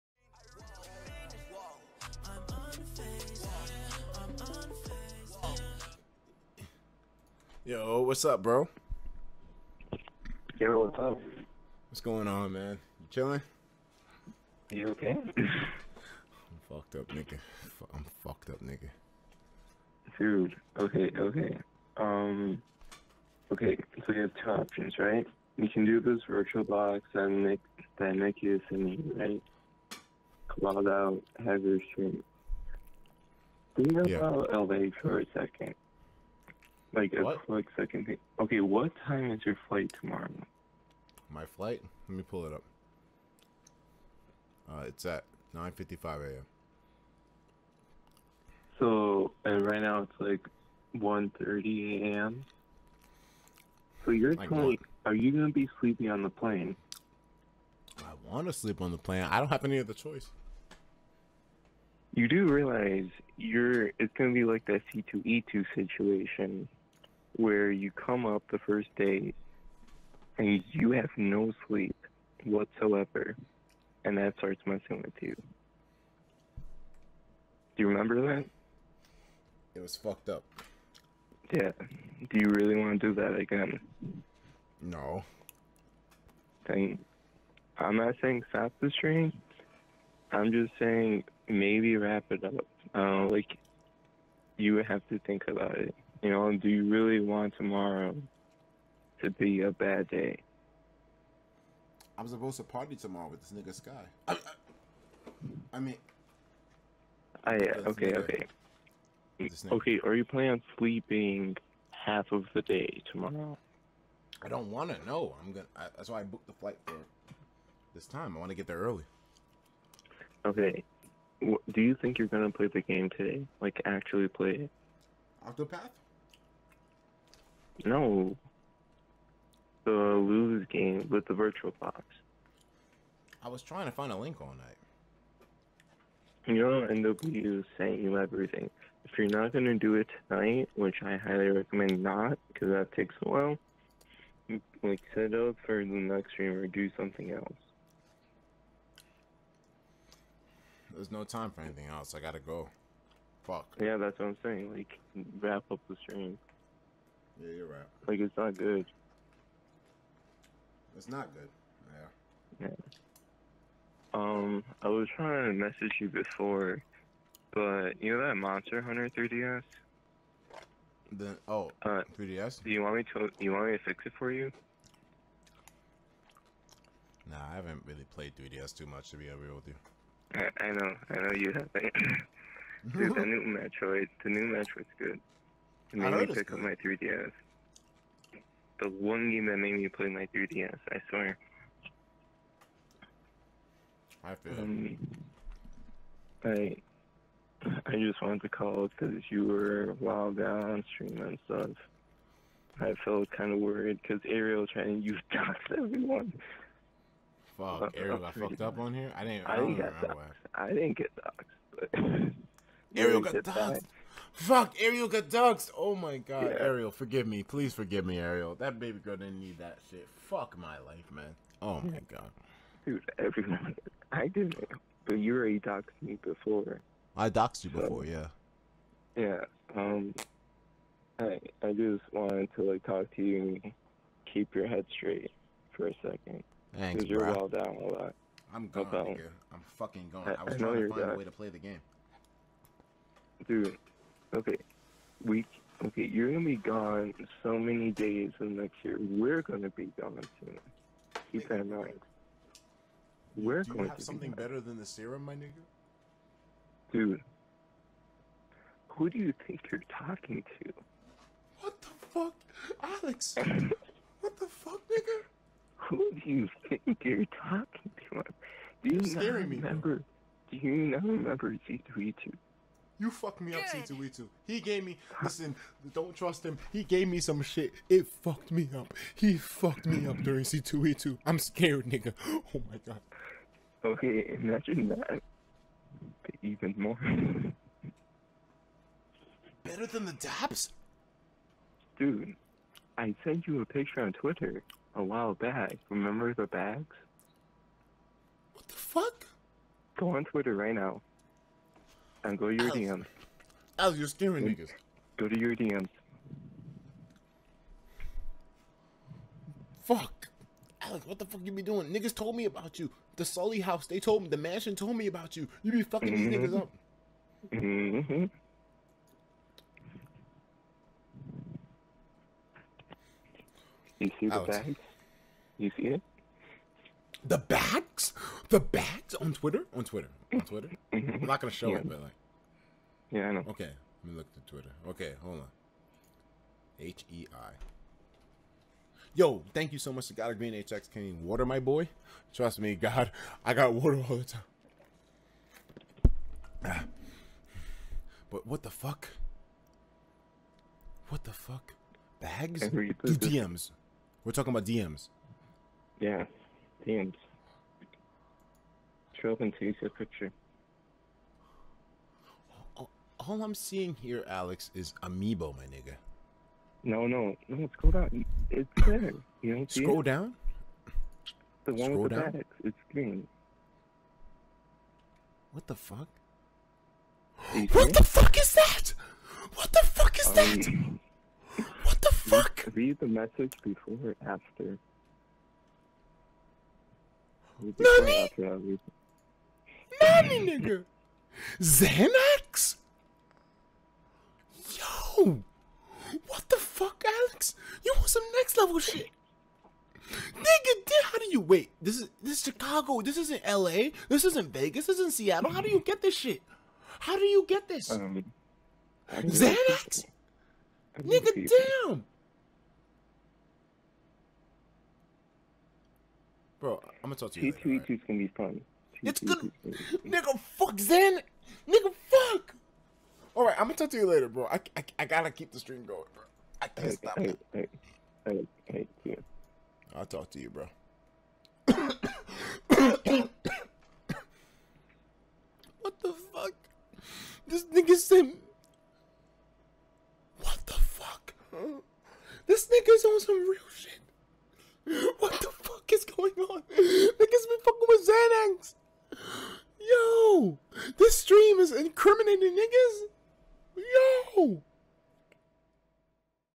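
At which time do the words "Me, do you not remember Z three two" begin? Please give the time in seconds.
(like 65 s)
270 s.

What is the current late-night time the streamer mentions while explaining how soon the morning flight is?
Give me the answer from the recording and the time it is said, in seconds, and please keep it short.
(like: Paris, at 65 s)
1:30 a.m., at 51 s.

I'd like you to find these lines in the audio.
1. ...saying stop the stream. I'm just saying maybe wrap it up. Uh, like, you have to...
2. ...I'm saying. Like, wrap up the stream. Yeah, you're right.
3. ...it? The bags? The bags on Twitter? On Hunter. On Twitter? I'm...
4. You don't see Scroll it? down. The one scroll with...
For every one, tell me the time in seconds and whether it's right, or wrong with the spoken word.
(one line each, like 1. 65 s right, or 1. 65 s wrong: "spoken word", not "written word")
1. 88 s right
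2. 154 s right
3. 325 s wrong: "Twitter", not "Hunter"
4. 369 s right.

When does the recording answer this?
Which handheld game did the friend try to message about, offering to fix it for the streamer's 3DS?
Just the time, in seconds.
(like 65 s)
168 s.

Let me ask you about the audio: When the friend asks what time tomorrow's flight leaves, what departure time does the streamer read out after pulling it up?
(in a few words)
9:55 a.m.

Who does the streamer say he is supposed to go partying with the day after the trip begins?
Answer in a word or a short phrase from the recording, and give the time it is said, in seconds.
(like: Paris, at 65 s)
Sky, at 103 s.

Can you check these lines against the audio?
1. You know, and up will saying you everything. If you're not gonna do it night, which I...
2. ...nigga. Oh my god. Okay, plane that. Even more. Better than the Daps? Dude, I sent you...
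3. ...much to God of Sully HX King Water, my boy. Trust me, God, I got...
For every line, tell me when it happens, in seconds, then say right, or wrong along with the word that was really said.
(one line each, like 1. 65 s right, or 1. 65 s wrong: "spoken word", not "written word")
1. 136 s wrong: "tonight", not "night"
2. 281 s wrong: "imagine", not "plane"
3. 339 s wrong: "Green", not "Sully".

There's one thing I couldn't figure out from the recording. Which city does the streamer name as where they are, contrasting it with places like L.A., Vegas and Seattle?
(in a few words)
Chicago.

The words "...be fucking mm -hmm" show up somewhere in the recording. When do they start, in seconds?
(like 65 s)
315 s.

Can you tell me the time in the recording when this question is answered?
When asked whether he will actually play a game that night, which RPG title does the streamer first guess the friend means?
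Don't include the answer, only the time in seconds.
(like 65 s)
125 s.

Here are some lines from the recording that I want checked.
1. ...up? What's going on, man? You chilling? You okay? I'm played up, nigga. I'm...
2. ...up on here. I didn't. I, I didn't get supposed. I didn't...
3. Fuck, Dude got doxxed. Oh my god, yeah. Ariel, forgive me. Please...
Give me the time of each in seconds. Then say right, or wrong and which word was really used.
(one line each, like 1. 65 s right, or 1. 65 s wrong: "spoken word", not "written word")
1. 10 s wrong: "fucked", not "played"
2. 208 s wrong: "doxed", not "supposed"
3. 214 s wrong: "Ariel", not "Dude".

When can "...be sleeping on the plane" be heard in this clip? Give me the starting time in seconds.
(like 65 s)
55 s.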